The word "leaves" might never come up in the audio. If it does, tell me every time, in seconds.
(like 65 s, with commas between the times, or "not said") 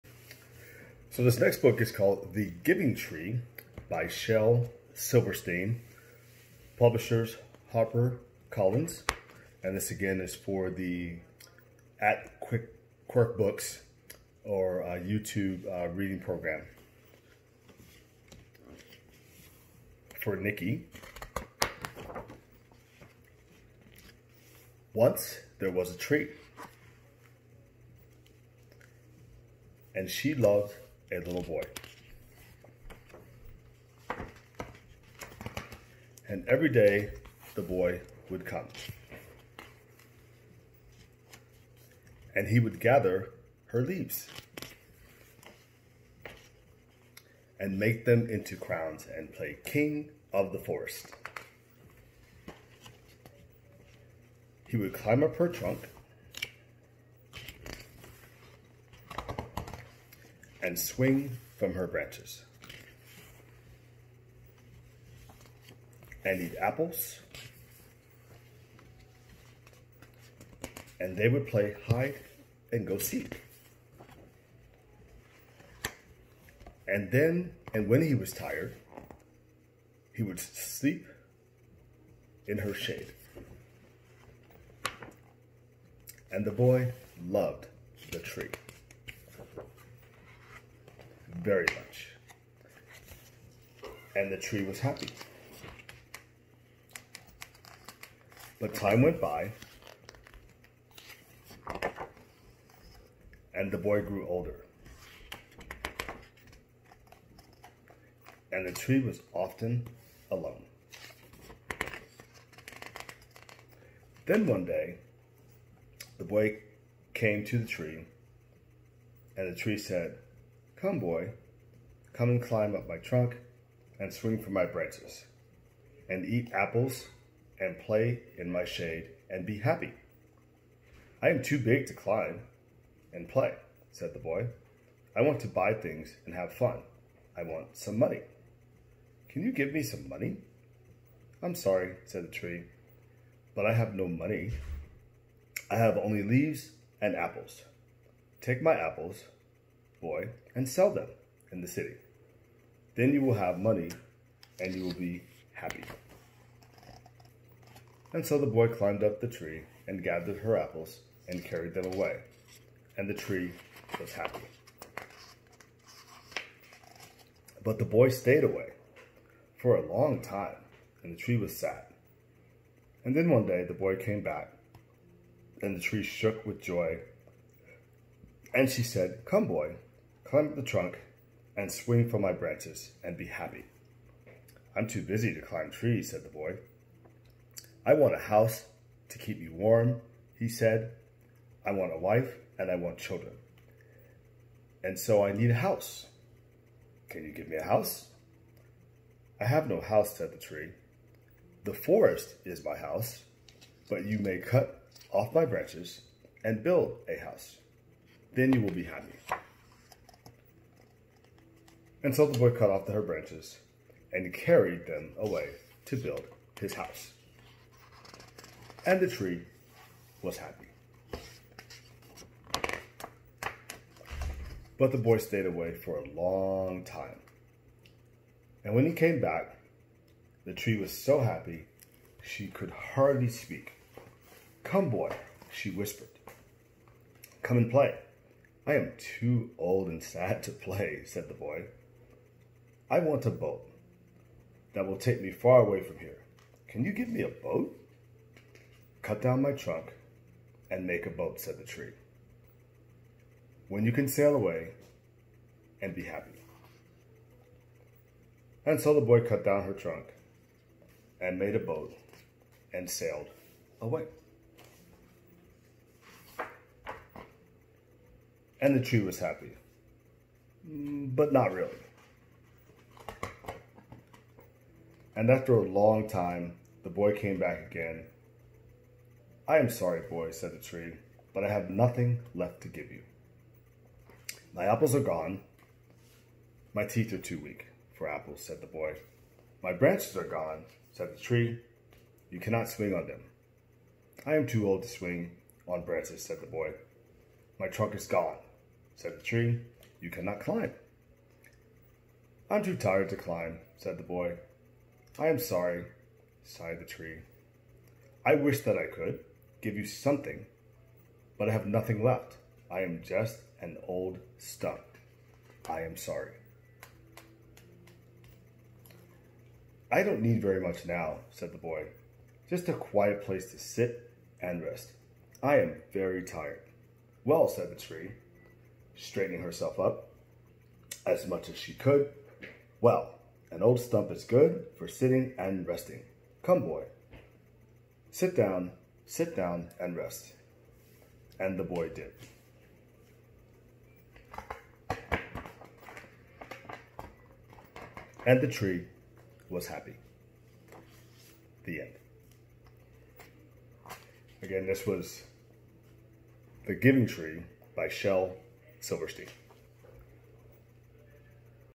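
43 s, 146 s.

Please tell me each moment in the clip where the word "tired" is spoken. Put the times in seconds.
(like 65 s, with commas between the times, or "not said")
78 s, 302 s, 326 s.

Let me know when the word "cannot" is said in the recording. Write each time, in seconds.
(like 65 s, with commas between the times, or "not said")
292 s, 300 s.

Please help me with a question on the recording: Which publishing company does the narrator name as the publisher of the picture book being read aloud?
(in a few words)
Harper Collins.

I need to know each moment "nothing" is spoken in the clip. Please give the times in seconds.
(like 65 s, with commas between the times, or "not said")
281 s, 311 s.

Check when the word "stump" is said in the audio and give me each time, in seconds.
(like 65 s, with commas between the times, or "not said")
314 s, 333 s.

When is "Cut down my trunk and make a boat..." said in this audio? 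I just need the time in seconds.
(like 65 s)
249 s.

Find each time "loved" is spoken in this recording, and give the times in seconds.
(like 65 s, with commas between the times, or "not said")
30 s, 87 s.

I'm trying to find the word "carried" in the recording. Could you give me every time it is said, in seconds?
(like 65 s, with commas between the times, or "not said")
161 s, 214 s.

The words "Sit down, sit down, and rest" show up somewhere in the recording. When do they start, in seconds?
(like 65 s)
338 s.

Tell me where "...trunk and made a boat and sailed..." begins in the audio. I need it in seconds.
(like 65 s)
259 s.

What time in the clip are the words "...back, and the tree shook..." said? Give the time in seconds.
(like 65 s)
174 s.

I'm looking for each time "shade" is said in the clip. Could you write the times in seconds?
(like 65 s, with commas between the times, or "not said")
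82 s, 128 s.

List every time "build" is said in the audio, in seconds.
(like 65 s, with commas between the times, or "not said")
206 s, 215 s.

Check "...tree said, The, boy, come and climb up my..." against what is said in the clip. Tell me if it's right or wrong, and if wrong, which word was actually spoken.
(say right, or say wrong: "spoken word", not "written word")
wrong: "Come", not "The".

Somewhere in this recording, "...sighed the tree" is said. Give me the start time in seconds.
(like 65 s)
306 s.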